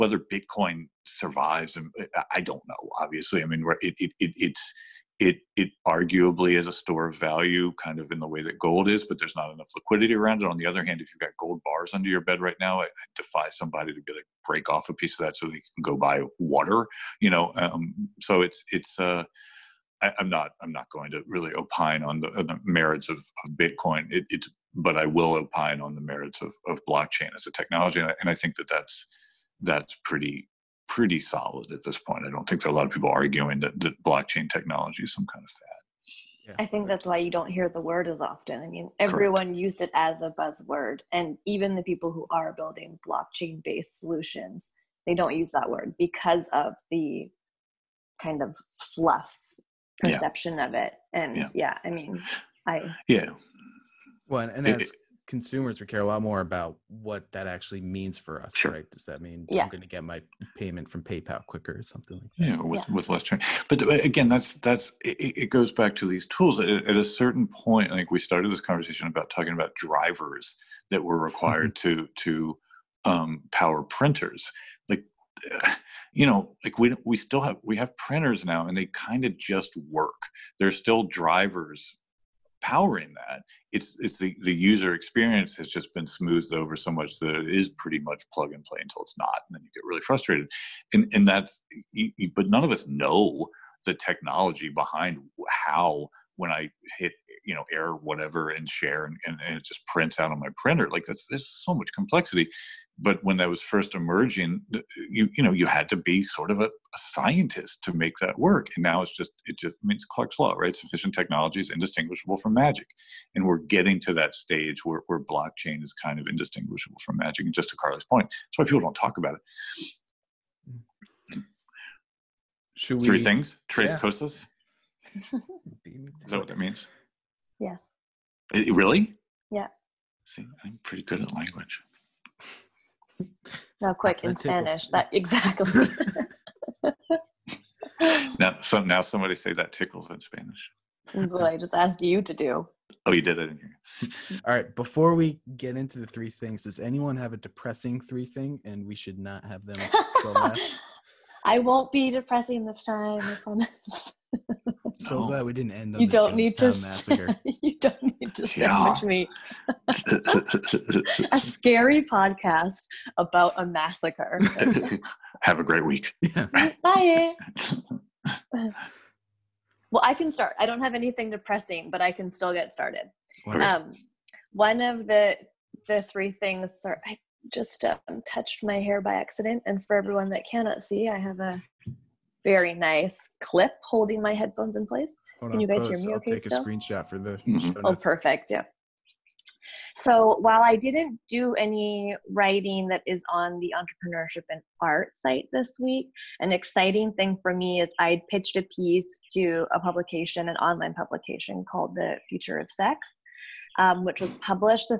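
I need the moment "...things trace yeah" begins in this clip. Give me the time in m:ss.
2:03.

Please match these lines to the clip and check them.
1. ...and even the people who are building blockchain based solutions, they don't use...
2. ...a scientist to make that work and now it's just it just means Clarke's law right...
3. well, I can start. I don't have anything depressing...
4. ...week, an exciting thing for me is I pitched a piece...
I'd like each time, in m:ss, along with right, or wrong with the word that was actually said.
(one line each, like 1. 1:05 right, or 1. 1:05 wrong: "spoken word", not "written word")
1. 0:41 right
2. 1:46 right
3. 2:48 right
4. 3:15 right.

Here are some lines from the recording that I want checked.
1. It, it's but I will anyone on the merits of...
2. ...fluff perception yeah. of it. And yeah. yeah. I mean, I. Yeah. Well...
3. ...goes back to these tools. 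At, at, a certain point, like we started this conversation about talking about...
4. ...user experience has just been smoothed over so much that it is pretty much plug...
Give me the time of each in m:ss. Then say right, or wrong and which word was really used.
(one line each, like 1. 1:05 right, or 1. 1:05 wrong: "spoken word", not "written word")
1. 0:24 wrong: "opine", not "anyone"
2. 0:48 right
3. 1:05 right
4. 1:24 right.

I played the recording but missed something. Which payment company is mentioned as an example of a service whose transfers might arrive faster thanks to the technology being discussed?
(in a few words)
PayPal.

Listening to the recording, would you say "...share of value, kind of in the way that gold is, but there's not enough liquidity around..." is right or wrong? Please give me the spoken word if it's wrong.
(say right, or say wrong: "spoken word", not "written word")
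wrong: "store", not "share".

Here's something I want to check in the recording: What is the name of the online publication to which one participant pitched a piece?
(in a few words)
The Future of Sex.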